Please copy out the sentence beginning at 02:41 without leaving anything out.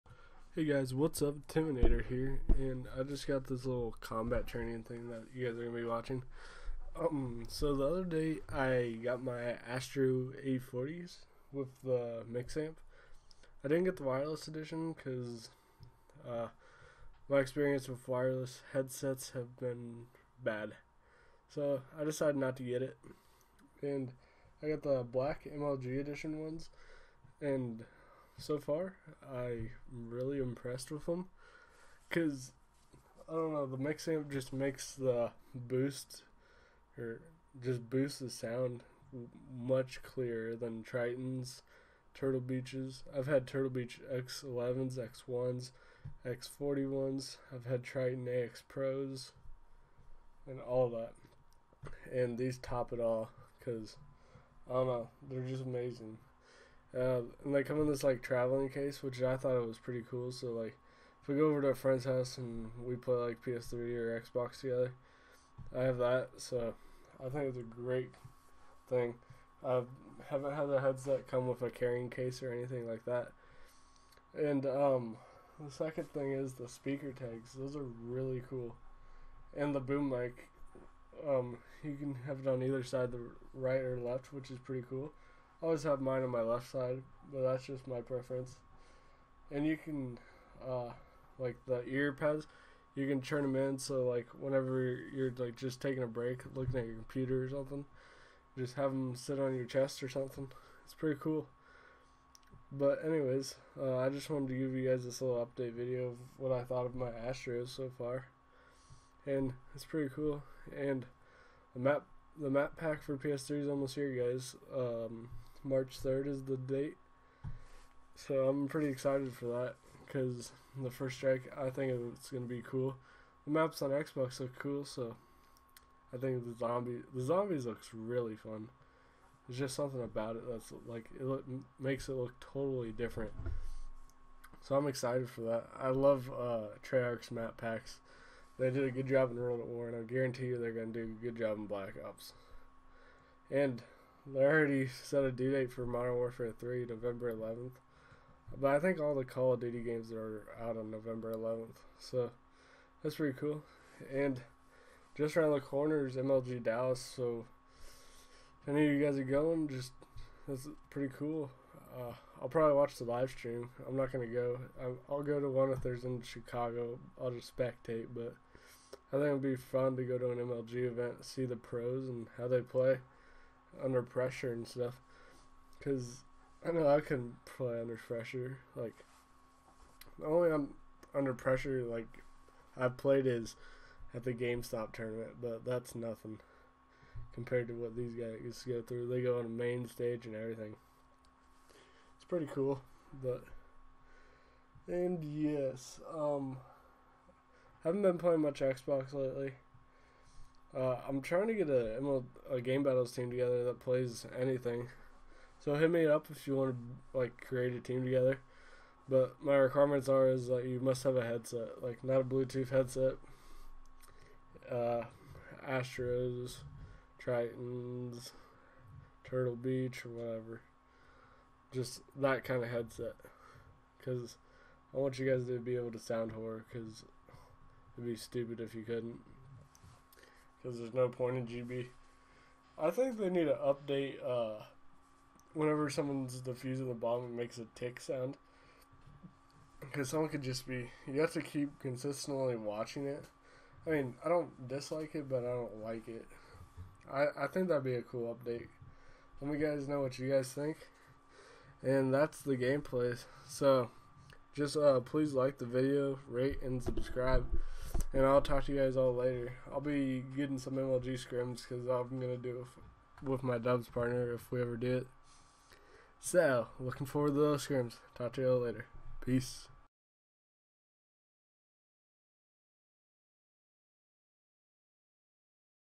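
Uh, I'll probably watch the live stream.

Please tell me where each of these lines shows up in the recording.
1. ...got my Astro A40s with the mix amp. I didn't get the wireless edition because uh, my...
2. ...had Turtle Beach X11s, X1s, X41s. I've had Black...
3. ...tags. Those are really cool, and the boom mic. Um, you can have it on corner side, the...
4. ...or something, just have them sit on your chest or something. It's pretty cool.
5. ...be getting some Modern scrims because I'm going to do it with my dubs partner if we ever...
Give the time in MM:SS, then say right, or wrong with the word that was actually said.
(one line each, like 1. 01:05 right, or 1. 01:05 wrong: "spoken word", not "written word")
1. 00:09 right
2. 00:43 wrong: "Tritton", not "Black"
3. 01:17 wrong: "either", not "corner"
4. 01:37 right
5. 04:19 wrong: "MLG", not "Modern".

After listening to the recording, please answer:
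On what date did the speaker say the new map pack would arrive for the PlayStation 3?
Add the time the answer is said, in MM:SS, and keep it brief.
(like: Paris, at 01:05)
March 3rd, at 01:55.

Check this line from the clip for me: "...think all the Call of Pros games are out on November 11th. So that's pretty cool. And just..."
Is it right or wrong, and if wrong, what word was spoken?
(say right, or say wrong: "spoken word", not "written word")
wrong: "Duty", not "Pros".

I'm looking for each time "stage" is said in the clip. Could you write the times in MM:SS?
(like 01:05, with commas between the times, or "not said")
03:09.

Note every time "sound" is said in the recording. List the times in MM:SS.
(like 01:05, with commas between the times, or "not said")
00:38, 03:45, 03:57.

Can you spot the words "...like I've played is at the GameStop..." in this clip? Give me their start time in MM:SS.
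03:01.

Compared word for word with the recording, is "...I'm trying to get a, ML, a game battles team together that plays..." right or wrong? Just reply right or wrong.
right.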